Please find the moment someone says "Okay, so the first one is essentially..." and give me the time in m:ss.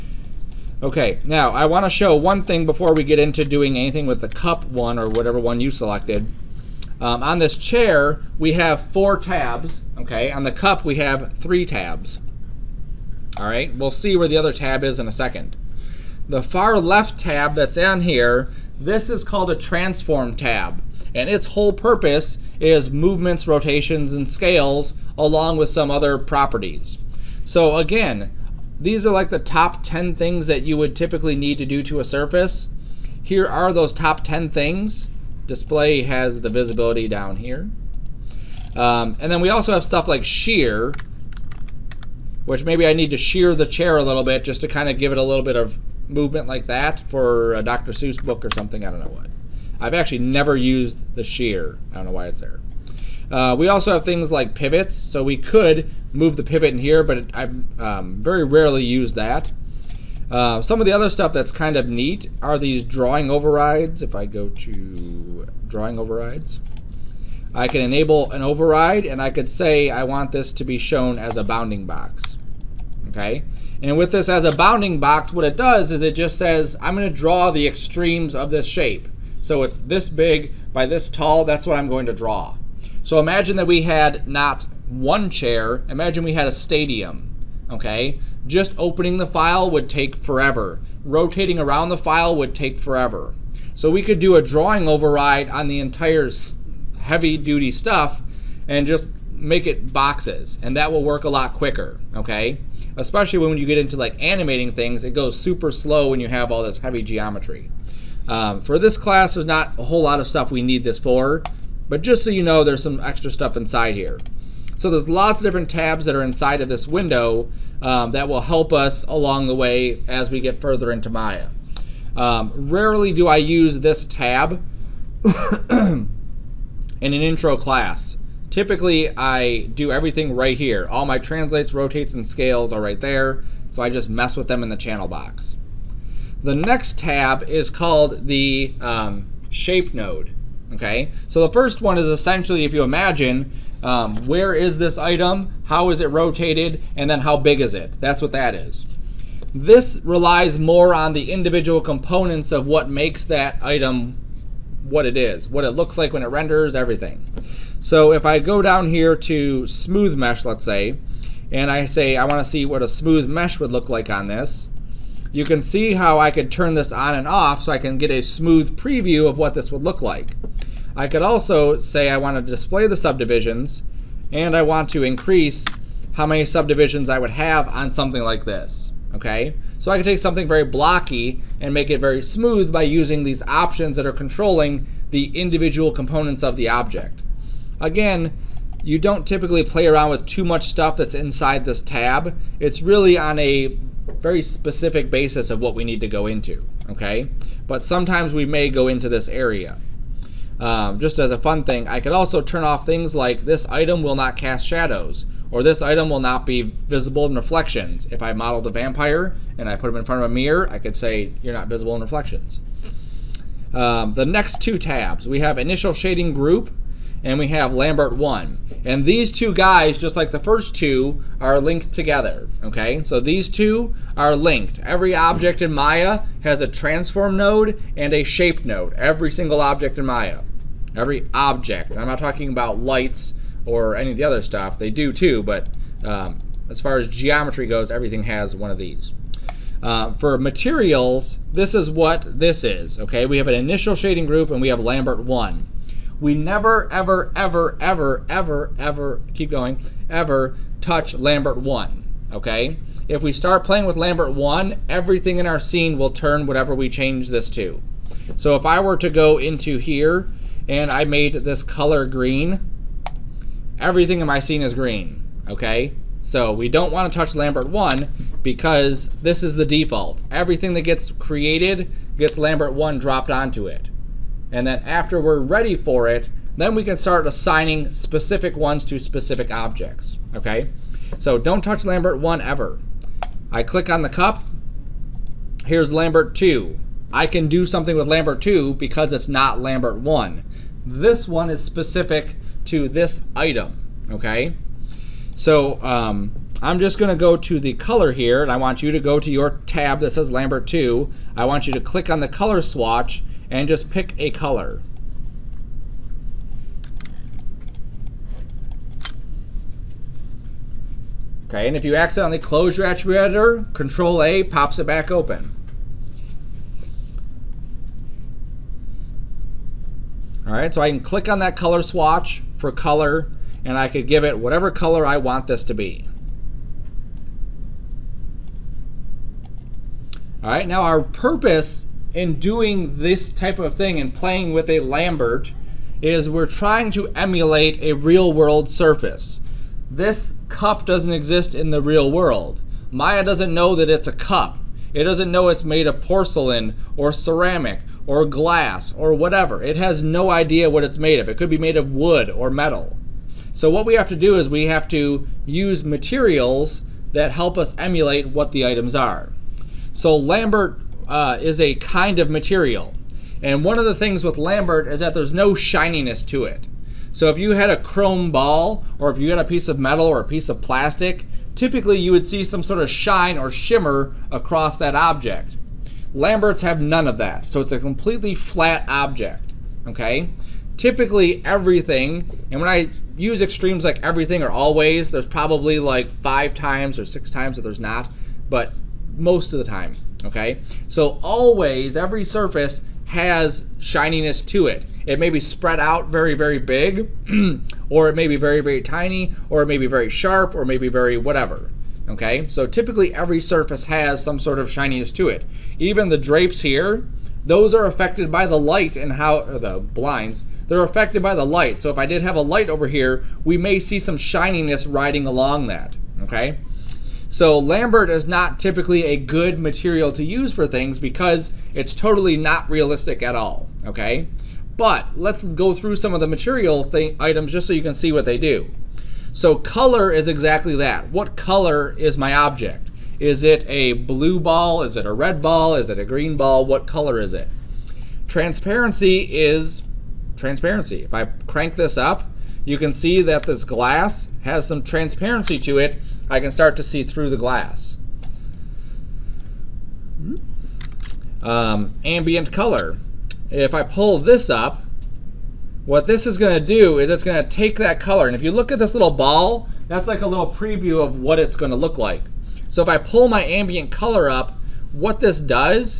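2:20.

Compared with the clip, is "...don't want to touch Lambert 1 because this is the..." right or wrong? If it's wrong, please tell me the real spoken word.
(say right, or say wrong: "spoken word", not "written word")
right.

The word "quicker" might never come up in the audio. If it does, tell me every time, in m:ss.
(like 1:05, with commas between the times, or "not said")
1:41.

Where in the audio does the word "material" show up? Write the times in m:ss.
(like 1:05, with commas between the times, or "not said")
4:00, 5:55, 6:02, 6:59, 7:06.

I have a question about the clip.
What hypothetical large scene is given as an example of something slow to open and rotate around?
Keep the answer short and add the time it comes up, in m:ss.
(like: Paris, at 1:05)
A stadium, at 1:26.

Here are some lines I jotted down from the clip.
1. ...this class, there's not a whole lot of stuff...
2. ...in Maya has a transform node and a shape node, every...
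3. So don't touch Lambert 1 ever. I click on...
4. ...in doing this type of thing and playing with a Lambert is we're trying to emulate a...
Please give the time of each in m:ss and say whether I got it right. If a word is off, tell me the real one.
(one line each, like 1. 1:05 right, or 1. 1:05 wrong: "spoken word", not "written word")
1. 1:48 right
2. 3:45 right
3. 4:41 right
4. 5:32 right.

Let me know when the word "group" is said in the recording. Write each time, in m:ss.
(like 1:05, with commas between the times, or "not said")
3:36, 4:04.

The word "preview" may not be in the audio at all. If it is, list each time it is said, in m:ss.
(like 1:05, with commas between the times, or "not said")
2:48, 7:40.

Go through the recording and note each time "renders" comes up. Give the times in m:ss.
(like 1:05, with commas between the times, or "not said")
2:36.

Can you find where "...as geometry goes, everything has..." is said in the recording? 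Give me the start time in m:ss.
3:56.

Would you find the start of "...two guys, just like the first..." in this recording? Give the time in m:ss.
3:39.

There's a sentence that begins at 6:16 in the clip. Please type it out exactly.
Lamberts have none of that, so it's a completely flat object, okay?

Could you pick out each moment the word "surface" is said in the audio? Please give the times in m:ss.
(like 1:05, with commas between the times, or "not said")
0:32, 5:38, 6:32, 6:43.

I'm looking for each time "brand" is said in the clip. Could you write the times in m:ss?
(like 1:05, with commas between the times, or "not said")
not said.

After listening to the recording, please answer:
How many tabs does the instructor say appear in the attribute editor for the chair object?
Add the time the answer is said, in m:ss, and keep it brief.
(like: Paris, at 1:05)
4, at 0:08.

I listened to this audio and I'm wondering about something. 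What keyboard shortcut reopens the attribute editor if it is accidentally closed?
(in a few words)
Control A.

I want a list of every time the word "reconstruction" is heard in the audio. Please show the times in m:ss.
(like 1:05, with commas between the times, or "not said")
not said.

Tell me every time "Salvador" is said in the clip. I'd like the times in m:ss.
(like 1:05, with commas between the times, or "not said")
not said.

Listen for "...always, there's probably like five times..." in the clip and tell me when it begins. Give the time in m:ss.
6:24.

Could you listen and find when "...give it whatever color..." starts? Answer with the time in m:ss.
5:24.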